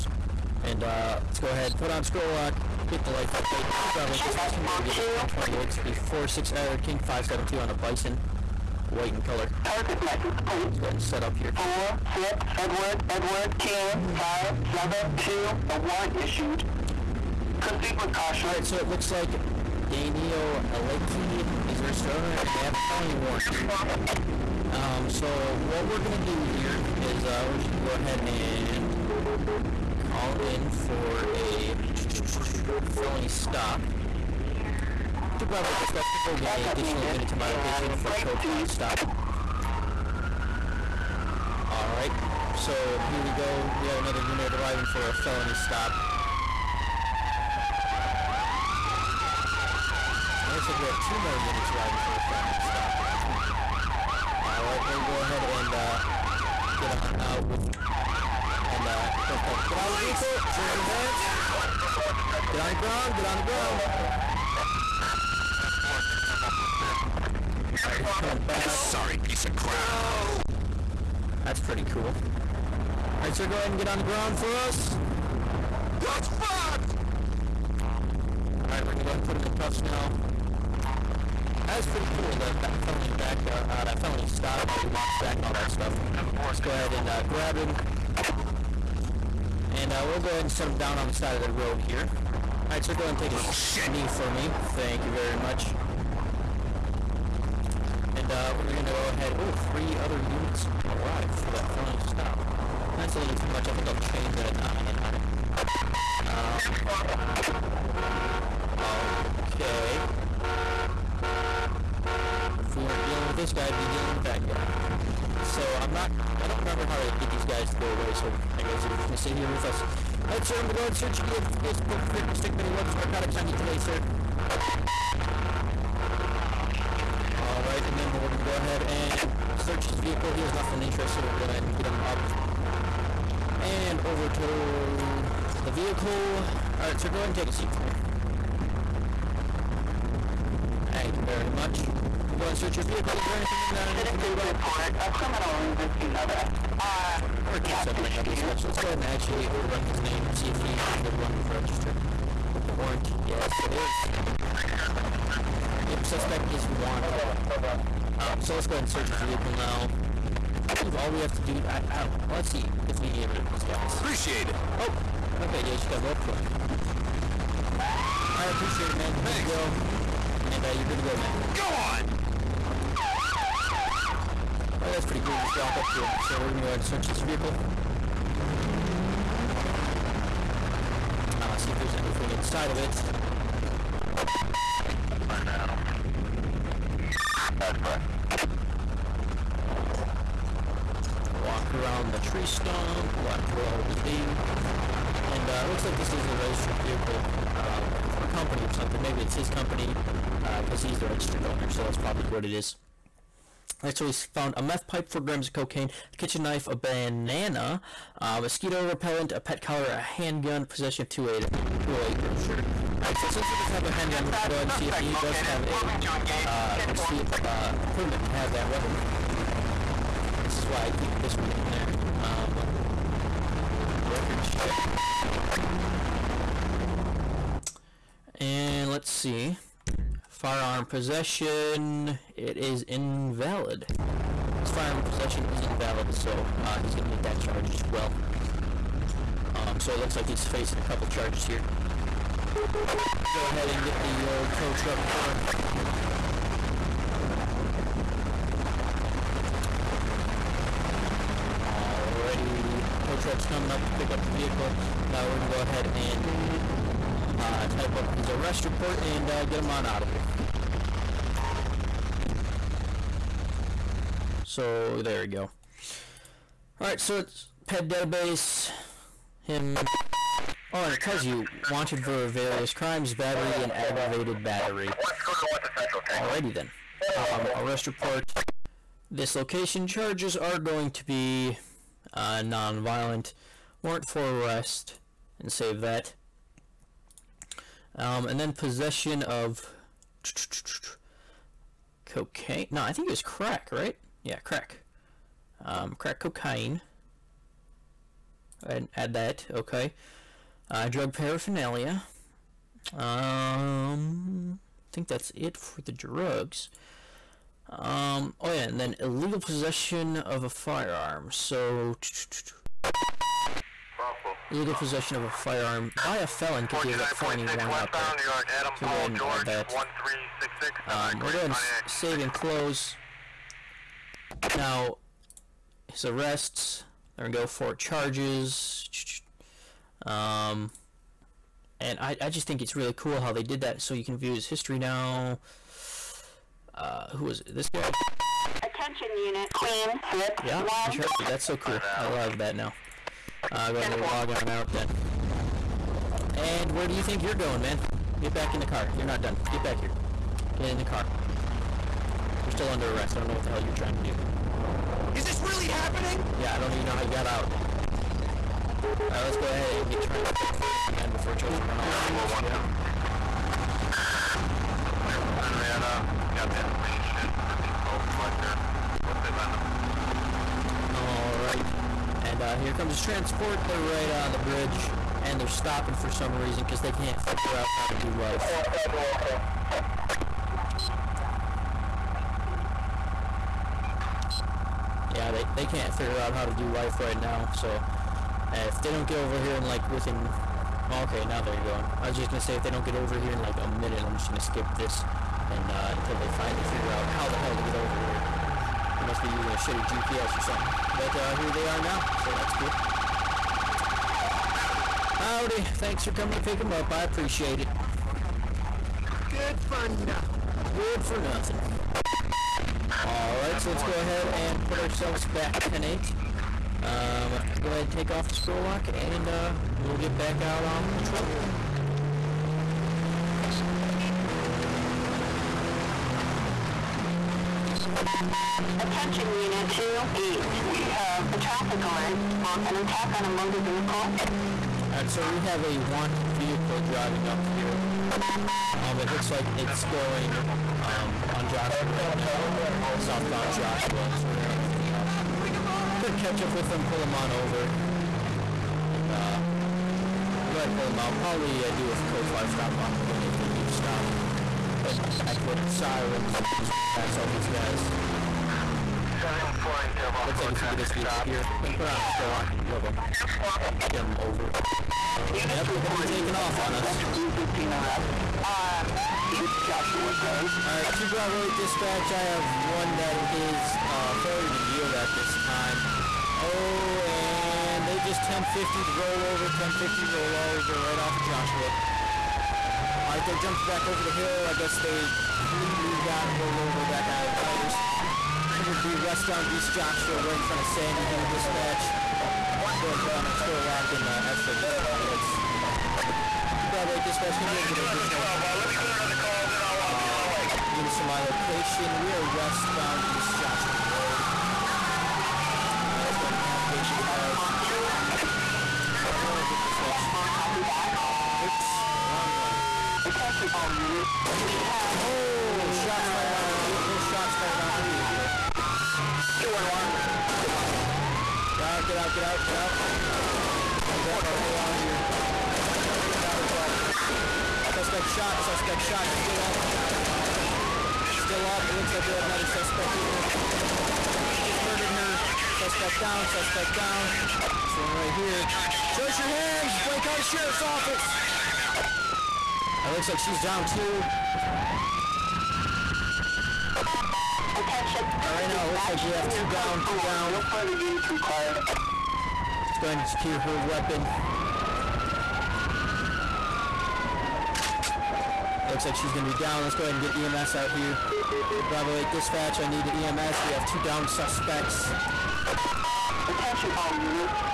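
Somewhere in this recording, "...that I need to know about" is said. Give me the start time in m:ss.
2:23.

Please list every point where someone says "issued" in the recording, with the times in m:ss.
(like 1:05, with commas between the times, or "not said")
0:16.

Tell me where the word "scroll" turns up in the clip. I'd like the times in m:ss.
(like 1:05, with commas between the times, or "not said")
0:02, 6:58, 8:13.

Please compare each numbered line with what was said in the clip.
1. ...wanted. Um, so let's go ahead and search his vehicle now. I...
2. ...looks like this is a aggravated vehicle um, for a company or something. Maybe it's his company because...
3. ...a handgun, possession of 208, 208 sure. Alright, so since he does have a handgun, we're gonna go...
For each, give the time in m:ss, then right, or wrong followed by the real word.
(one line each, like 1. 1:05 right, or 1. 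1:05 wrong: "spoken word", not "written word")
1. 2:36 right
2. 3:15 wrong: "registered", not "aggravated"
3. 3:29 right.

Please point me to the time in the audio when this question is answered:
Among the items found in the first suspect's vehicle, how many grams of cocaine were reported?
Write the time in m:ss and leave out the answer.
3:25.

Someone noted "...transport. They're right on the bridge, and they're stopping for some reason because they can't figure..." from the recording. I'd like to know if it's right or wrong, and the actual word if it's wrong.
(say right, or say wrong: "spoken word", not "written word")
right.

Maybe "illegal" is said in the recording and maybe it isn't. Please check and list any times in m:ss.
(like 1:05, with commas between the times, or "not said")
5:09, 5:14.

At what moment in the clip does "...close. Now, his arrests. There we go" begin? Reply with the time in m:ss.
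5:22.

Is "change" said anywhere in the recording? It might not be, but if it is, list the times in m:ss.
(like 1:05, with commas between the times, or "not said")
1:44.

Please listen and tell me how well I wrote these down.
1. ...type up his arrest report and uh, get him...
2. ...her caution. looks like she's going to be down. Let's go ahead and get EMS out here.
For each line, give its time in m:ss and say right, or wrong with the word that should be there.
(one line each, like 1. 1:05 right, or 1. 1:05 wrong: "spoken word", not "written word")
1. 4:17 right
2. 9:13 wrong: "weapon", not "caution".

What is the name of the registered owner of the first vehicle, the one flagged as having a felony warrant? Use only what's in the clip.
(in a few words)
Daniel Aleki.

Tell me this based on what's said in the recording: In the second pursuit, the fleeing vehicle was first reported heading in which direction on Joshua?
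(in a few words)
southbound.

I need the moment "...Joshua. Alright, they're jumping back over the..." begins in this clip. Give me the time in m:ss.
8:01.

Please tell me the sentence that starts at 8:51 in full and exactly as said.
Still up, it looks like we have another suspect She just murdered her.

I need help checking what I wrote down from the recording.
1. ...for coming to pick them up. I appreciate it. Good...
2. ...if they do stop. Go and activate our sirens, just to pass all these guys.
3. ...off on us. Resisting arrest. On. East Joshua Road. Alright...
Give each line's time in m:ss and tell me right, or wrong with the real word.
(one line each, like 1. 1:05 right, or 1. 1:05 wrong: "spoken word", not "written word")
1. 6:46 right
2. 7:33 right
3. 7:46 right.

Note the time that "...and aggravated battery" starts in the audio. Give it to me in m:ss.
4:33.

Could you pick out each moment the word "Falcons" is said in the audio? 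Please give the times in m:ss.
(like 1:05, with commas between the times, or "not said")
not said.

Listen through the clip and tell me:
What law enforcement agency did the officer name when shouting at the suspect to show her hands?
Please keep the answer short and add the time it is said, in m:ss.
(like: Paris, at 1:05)
Blaine County Sheriff's Office, at 8:59.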